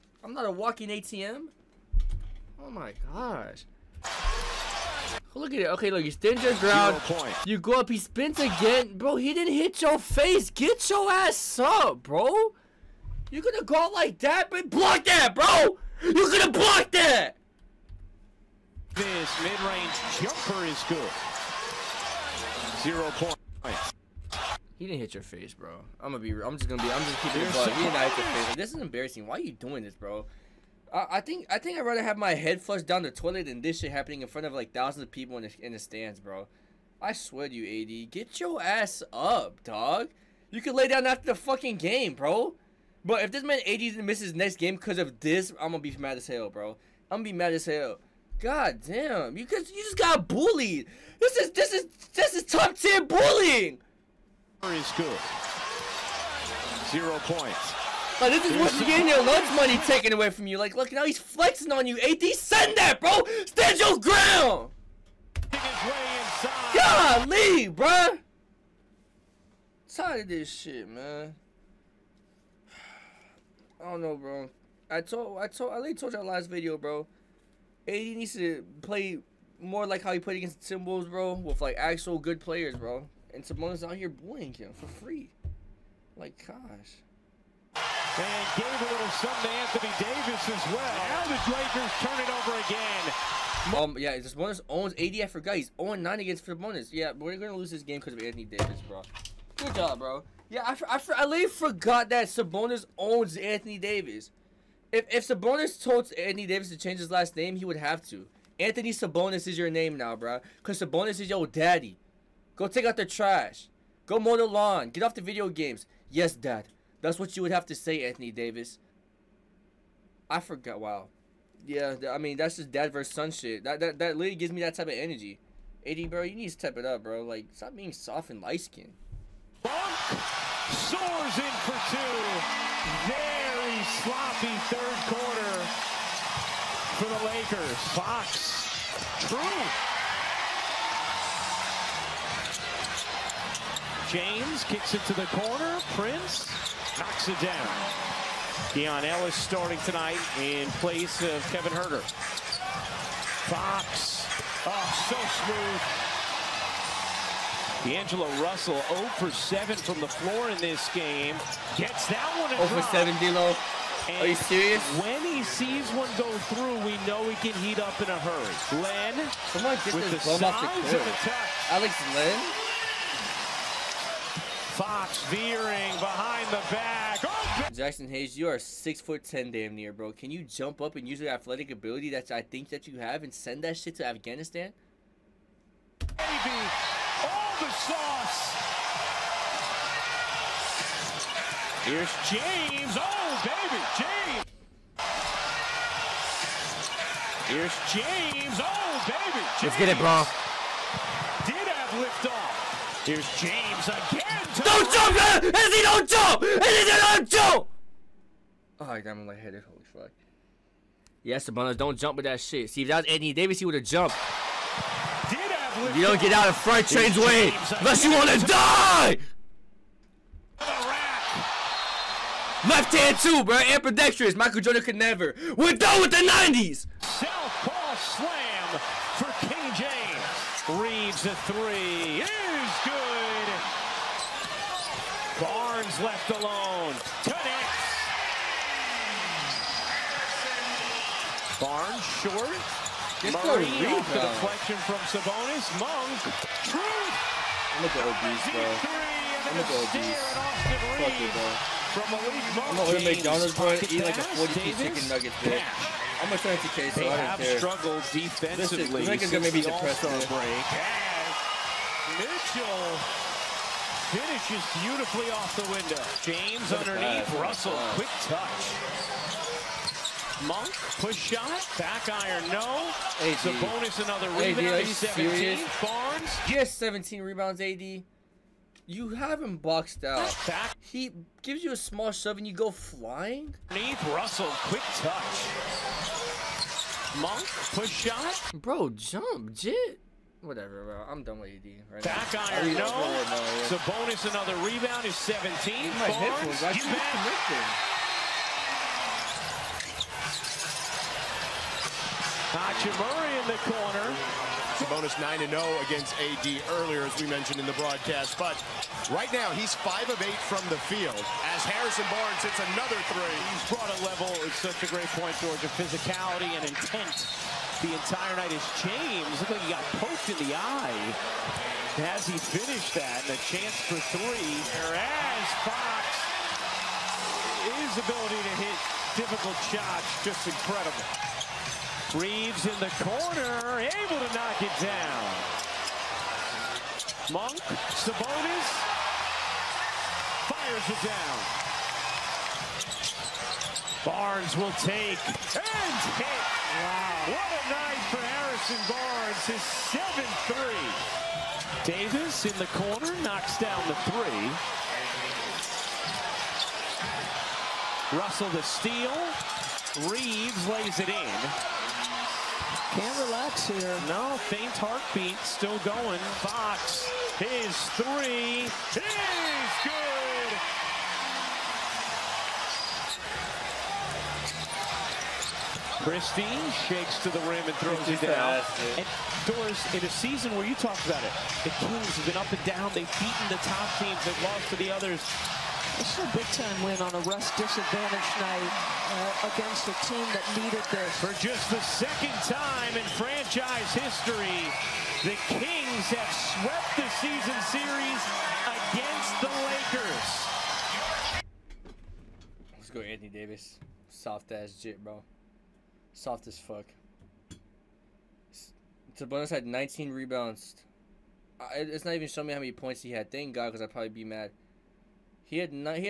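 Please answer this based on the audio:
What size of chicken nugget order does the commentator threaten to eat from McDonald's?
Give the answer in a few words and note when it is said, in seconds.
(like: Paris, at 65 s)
40 piece, at 254 s.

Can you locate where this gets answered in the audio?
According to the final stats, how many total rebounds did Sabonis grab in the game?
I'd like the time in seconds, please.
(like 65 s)
409 s.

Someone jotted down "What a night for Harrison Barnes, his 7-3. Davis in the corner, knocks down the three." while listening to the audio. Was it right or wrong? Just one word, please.
right.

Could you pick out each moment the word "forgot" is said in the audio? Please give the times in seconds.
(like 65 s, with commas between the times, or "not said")
95 s, 101 s, 120 s.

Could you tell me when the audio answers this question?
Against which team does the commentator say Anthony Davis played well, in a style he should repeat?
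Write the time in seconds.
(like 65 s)
80 s.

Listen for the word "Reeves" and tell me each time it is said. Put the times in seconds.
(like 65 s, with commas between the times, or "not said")
230 s, 332 s, 360 s.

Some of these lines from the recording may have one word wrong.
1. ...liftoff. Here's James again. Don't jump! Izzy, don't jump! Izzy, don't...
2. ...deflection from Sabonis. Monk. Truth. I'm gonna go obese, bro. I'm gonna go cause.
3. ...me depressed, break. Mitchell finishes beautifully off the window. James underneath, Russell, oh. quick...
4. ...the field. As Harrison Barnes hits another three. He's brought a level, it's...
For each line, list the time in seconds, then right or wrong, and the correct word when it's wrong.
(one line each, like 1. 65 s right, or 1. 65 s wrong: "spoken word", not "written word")
1. 202 s right
2. 244 s wrong: "obese", not "cause"
3. 259 s right
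4. 310 s right.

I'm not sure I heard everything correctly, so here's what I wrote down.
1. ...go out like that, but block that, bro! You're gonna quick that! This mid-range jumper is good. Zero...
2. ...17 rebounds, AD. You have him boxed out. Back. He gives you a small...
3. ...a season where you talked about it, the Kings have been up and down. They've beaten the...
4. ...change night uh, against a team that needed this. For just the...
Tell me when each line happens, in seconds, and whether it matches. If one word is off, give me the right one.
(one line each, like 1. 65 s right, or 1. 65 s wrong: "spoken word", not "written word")
1. 13 s wrong: "block", not "quick"
2. 276 s right
3. 380 s right
4. 387 s wrong: "disadvantage", not "change".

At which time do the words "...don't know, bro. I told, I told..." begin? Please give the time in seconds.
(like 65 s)
73 s.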